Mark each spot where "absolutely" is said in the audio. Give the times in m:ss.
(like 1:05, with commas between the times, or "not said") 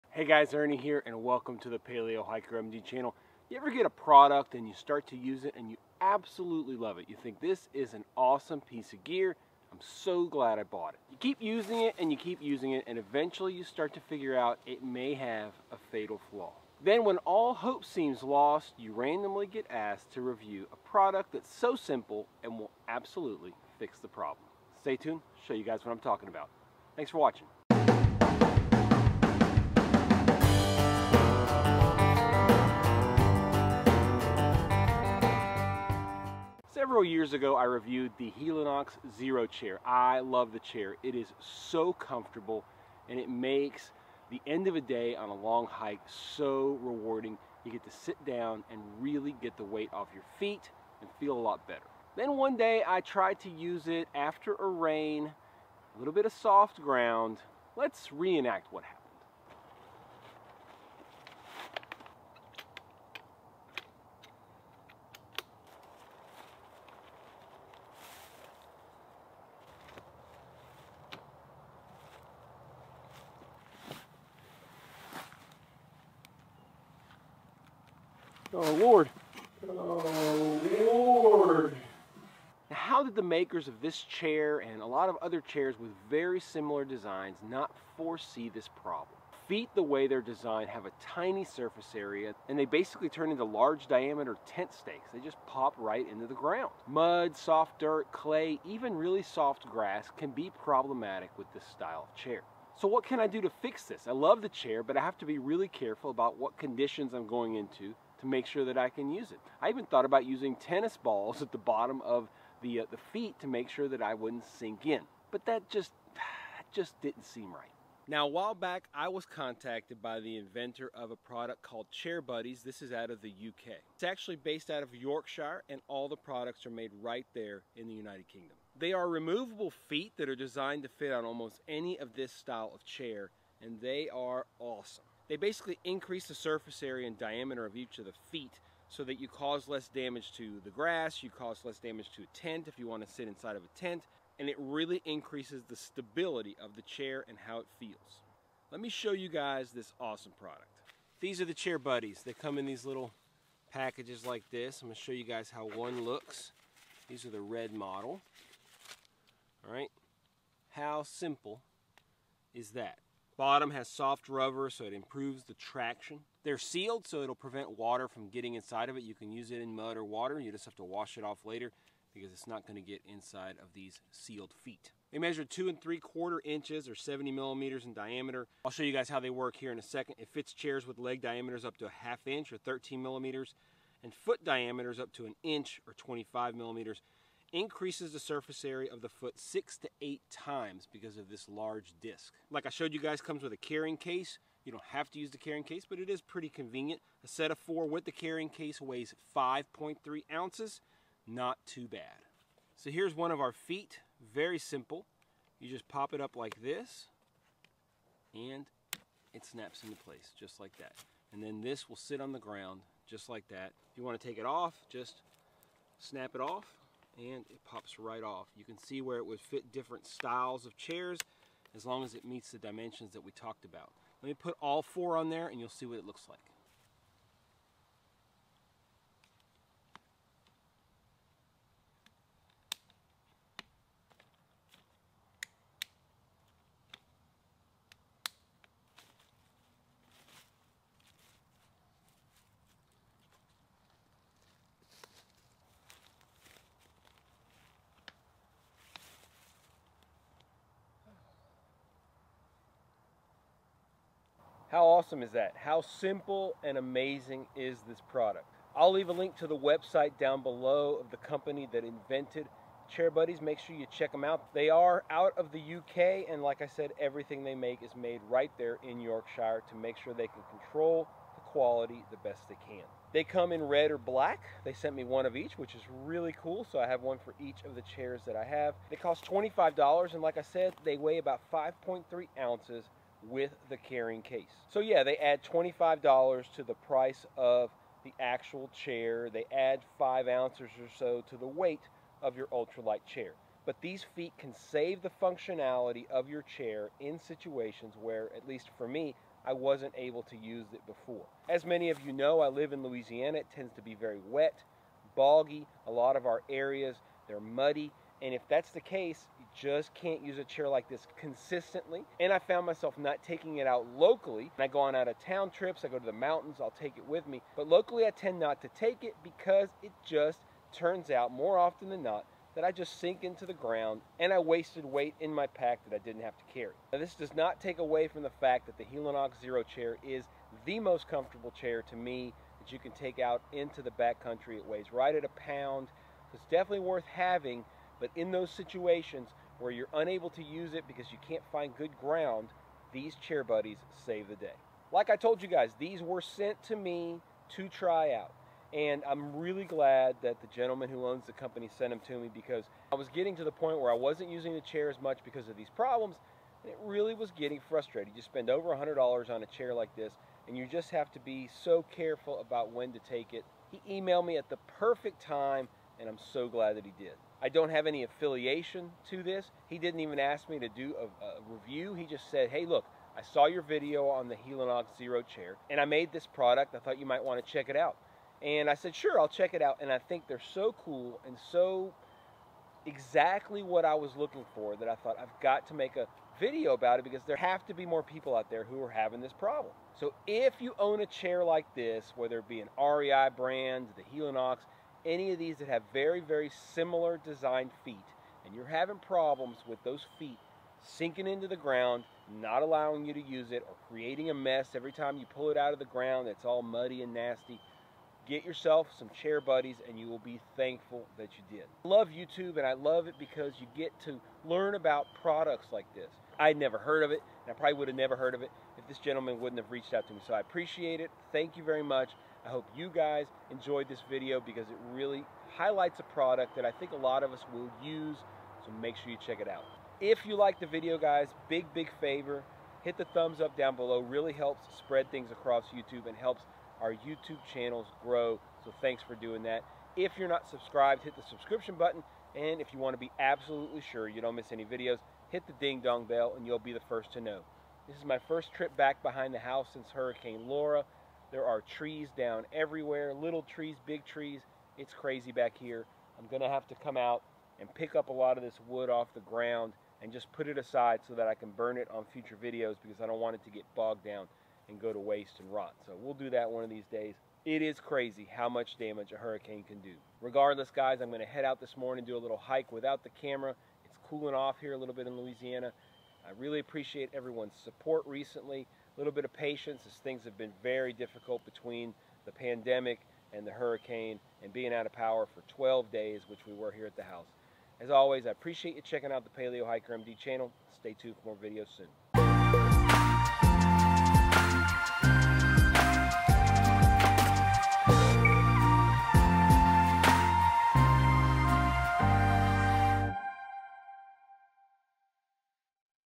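0:05, 0:22, 7:23.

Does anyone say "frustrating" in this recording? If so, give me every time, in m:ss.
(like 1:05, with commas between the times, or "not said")
5:57.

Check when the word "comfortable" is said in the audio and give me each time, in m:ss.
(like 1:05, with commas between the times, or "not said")
0:41, 5:31.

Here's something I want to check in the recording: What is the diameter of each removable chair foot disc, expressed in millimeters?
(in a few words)
70 millimeters.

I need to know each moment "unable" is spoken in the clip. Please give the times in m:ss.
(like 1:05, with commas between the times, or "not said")
5:39.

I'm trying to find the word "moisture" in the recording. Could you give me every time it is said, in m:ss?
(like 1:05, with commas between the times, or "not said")
not said.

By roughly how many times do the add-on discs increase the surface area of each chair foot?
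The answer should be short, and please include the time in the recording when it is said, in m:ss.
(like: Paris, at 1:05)
6 to 8 times, at 3:09.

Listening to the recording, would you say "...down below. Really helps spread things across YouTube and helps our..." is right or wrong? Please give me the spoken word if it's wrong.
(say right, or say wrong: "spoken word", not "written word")
right.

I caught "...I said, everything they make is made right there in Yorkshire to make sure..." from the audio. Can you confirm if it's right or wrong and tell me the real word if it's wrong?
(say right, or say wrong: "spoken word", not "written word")
right.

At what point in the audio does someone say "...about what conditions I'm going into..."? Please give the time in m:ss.
1:46.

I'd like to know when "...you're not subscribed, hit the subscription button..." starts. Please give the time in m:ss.
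7:20.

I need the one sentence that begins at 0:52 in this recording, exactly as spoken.
Then one day I tried to use it after a rain, a little bit of soft ground.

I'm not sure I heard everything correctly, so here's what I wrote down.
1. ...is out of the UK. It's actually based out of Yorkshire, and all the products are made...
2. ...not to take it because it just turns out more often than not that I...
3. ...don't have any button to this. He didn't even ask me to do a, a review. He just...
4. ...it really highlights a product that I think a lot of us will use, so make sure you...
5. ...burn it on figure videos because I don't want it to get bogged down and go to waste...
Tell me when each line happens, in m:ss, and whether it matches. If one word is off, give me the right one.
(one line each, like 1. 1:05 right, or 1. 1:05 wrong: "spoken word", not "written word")
1. 2:02 right
2. 5:18 right
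3. 6:07 wrong: "affiliation", not "button"
4. 7:04 right
5. 7:41 wrong: "future", not "figure".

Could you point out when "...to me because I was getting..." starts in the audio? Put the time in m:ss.
5:52.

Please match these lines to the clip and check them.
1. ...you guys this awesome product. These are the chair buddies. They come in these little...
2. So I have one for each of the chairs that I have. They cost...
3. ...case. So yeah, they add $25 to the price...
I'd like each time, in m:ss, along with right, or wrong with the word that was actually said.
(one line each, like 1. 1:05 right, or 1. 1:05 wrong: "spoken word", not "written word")
1. 2:29 right
2. 4:36 right
3. 4:44 right.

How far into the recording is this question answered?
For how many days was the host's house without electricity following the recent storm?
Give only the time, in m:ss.
8:05.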